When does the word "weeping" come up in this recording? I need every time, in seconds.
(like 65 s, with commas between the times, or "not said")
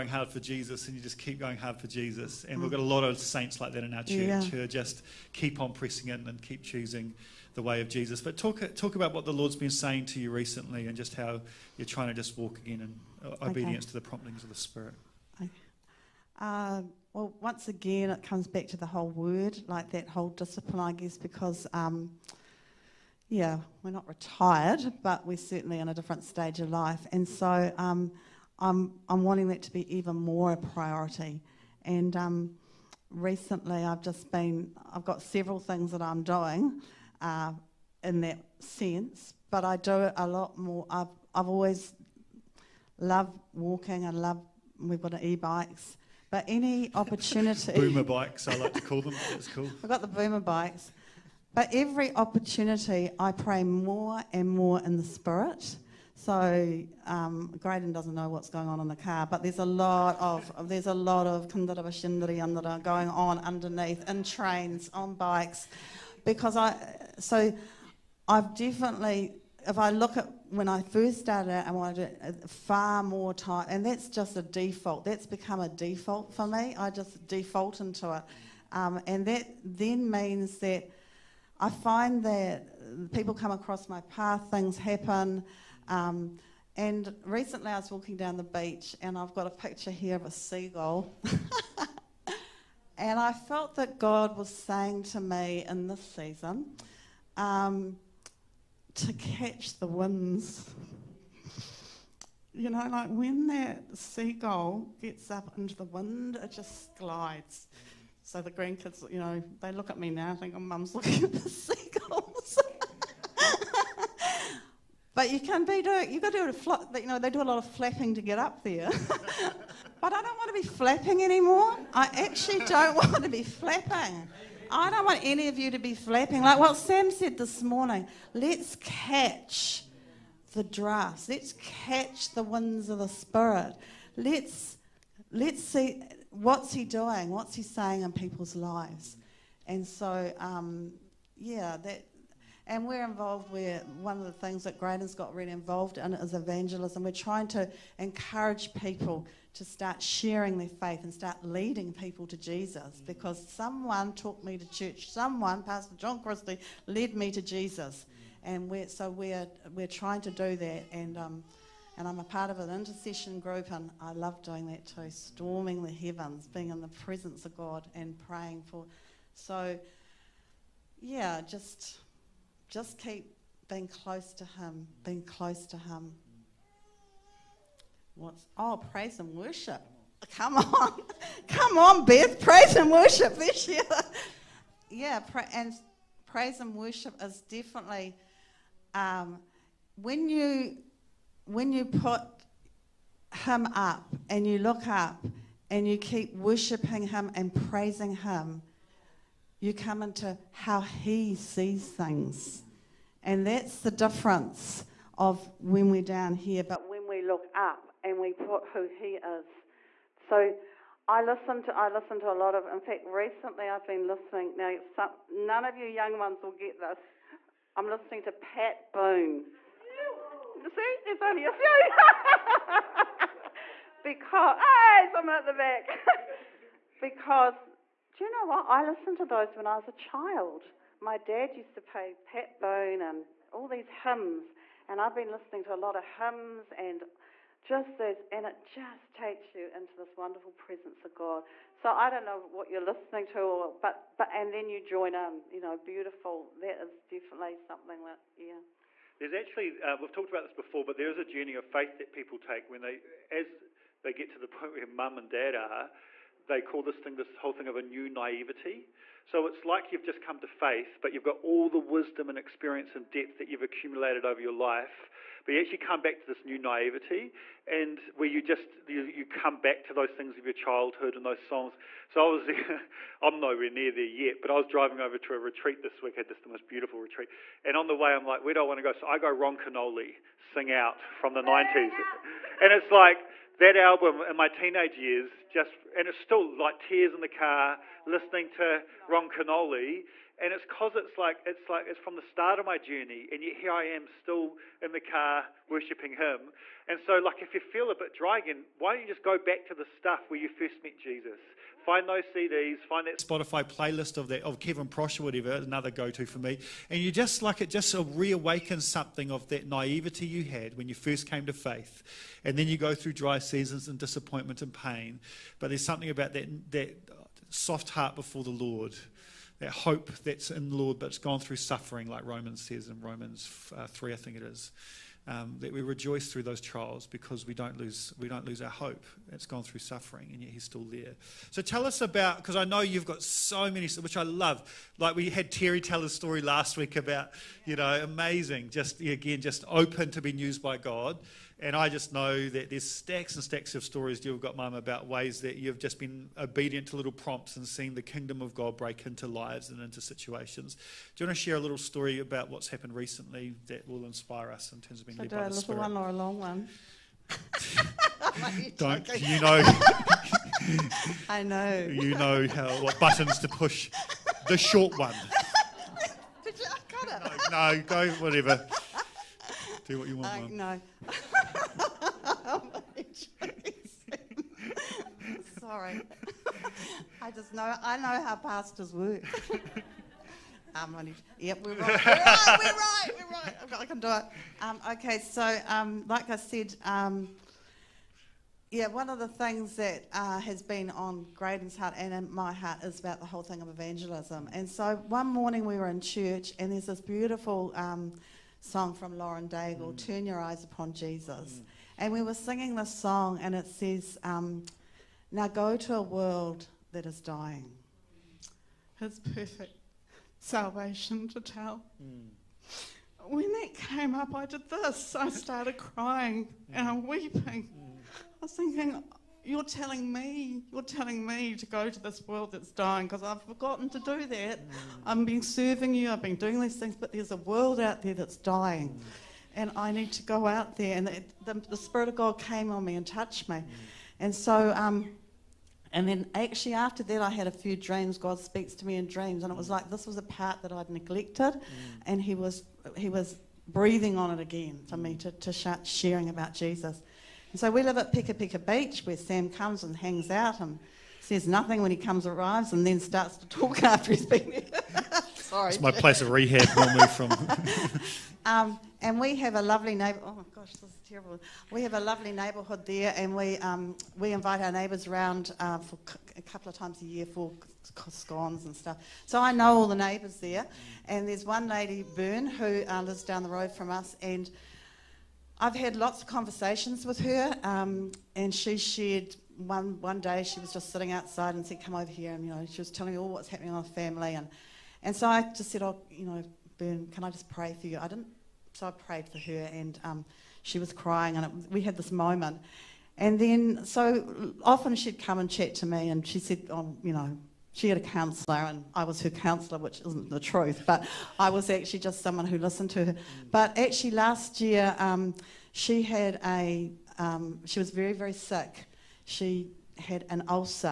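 417 s.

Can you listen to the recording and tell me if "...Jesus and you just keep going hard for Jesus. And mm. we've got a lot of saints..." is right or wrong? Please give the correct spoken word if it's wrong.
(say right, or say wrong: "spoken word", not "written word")
right.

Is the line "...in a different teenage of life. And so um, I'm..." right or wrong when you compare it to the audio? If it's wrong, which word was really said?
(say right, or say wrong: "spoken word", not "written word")
wrong: "stage", not "teenage".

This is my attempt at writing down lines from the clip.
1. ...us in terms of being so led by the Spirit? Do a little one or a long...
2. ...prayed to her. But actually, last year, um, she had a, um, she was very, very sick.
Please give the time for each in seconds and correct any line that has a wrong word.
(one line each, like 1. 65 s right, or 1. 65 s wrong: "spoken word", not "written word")
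1. 354 s right
2. 502 s wrong: "listened", not "prayed".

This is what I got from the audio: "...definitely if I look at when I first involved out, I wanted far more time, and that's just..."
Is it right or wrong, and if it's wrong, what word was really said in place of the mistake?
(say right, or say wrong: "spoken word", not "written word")
wrong: "started", not "involved".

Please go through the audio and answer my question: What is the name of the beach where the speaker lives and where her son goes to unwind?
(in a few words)
Pika Pika Beach.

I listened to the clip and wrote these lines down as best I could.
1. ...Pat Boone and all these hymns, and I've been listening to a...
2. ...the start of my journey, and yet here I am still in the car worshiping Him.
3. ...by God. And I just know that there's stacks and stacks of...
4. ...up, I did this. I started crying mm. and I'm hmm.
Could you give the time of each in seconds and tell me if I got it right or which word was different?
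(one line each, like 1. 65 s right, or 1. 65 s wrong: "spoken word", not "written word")
1. 232 s right
2. 292 s right
3. 340 s right
4. 414 s right.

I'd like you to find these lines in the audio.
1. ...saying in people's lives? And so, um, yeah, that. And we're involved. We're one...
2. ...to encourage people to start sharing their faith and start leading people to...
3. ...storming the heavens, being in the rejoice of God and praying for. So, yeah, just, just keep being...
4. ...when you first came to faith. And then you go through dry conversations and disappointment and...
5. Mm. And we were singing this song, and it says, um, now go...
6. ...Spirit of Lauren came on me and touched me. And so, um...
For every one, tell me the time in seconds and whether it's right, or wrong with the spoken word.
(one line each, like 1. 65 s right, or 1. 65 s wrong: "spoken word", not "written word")
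1. 137 s right
2. 147 s right
3. 165 s wrong: "presence", not "rejoice"
4. 310 s wrong: "seasons", not "conversations"
5. 401 s right
6. 431 s wrong: "God", not "Lauren".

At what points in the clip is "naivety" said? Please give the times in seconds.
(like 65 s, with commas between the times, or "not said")
258 s, 266 s, 309 s.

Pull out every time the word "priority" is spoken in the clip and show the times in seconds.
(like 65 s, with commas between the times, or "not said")
30 s.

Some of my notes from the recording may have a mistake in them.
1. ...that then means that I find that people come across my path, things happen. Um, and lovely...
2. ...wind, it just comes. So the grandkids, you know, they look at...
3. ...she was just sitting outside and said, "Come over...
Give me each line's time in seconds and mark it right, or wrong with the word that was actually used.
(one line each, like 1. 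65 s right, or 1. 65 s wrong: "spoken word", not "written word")
1. 79 s wrong: "recently", not "lovely"
2. 105 s wrong: "glides", not "comes"
3. 480 s right.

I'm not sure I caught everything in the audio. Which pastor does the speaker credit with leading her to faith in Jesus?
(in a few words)
John Christie.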